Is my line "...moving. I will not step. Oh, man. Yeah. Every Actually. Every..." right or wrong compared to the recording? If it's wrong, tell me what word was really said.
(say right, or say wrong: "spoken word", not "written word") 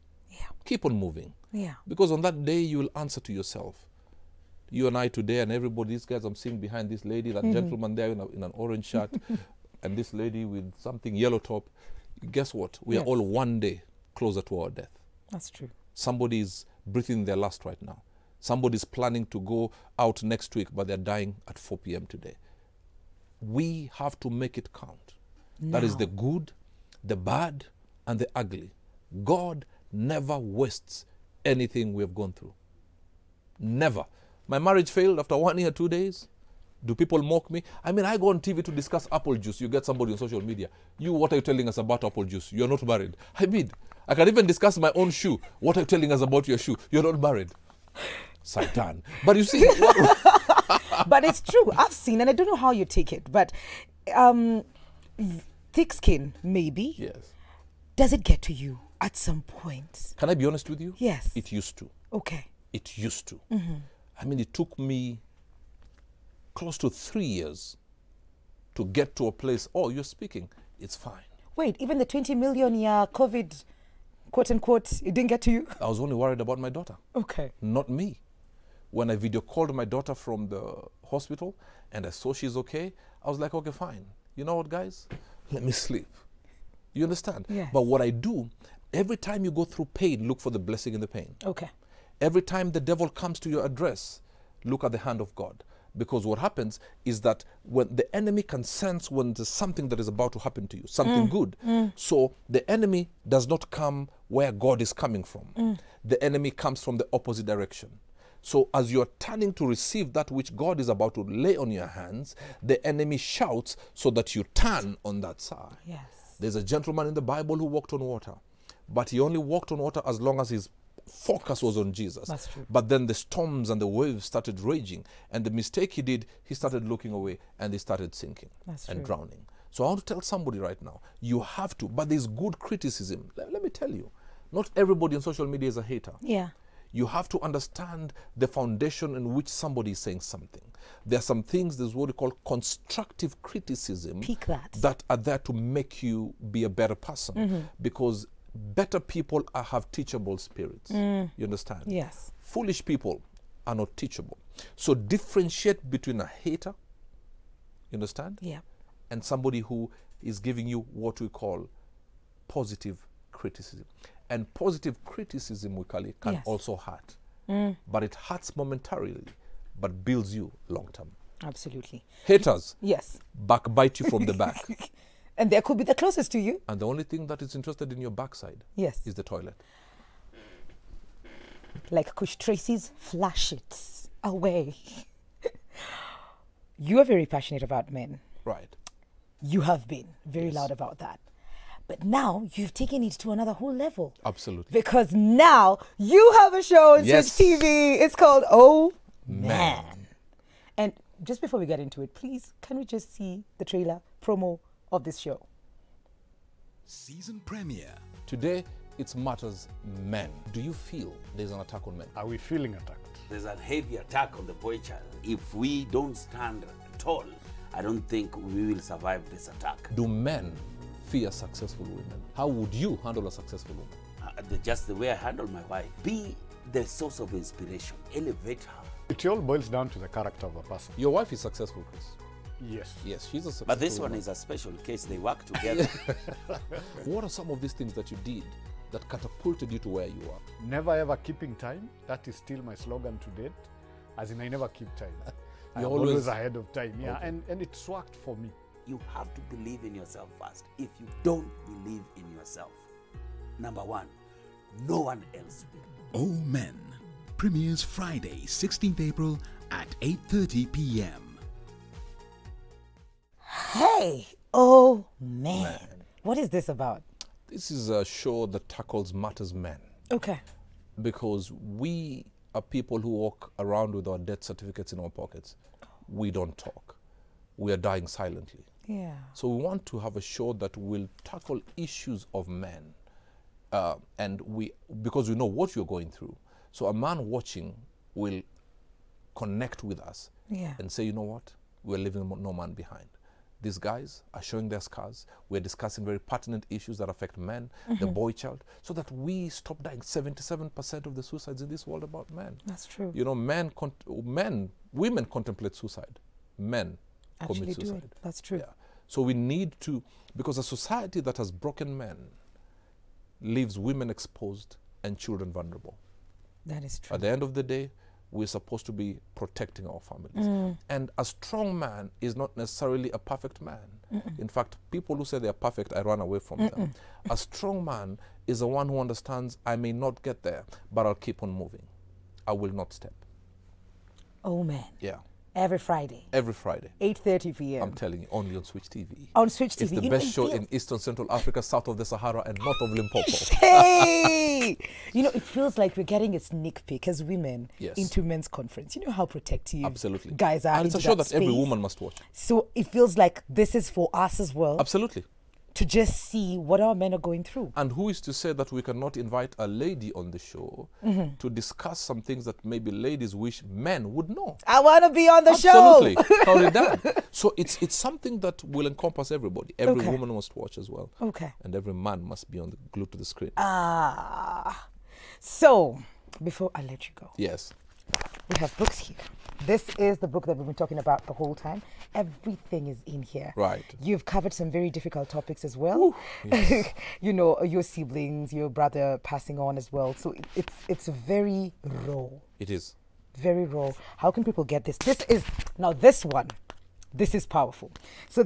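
wrong: "Friday", not "Actually".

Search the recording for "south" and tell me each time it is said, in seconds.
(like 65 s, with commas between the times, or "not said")
341 s.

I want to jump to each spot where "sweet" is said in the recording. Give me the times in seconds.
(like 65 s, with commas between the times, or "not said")
not said.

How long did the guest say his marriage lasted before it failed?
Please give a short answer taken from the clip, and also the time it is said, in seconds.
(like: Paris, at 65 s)
1 year, 2 days, at 35 s.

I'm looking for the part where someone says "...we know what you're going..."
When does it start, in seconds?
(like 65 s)
285 s.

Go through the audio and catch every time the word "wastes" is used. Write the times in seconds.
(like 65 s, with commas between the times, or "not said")
30 s.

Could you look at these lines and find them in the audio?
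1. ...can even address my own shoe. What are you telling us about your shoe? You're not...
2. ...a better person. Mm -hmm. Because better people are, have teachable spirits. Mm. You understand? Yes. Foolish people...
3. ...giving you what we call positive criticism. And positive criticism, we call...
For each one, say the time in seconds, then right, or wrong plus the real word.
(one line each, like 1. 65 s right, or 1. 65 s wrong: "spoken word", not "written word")
1. 44 s wrong: "discuss", not "address"
2. 146 s right
3. 160 s right.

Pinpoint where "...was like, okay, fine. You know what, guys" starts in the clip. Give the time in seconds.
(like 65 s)
83 s.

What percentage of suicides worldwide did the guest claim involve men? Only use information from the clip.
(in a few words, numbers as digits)
77%.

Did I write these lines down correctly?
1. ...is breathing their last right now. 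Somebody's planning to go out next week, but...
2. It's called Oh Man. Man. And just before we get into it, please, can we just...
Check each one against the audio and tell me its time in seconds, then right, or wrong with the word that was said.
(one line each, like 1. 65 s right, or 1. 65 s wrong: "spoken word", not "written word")
1. 16 s right
2. 197 s right.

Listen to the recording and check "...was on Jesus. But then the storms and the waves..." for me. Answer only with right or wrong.
right.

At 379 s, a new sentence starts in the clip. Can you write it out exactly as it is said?
This is the book that we've been talking about the whole time.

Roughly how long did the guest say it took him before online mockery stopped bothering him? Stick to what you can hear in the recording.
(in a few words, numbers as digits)
close to 3 years.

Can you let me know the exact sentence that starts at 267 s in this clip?
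This is a show that tackles matters men.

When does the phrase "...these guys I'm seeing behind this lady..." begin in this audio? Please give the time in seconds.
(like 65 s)
5 s.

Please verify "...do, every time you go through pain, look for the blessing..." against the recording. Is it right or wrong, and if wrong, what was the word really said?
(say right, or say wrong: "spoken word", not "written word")
right.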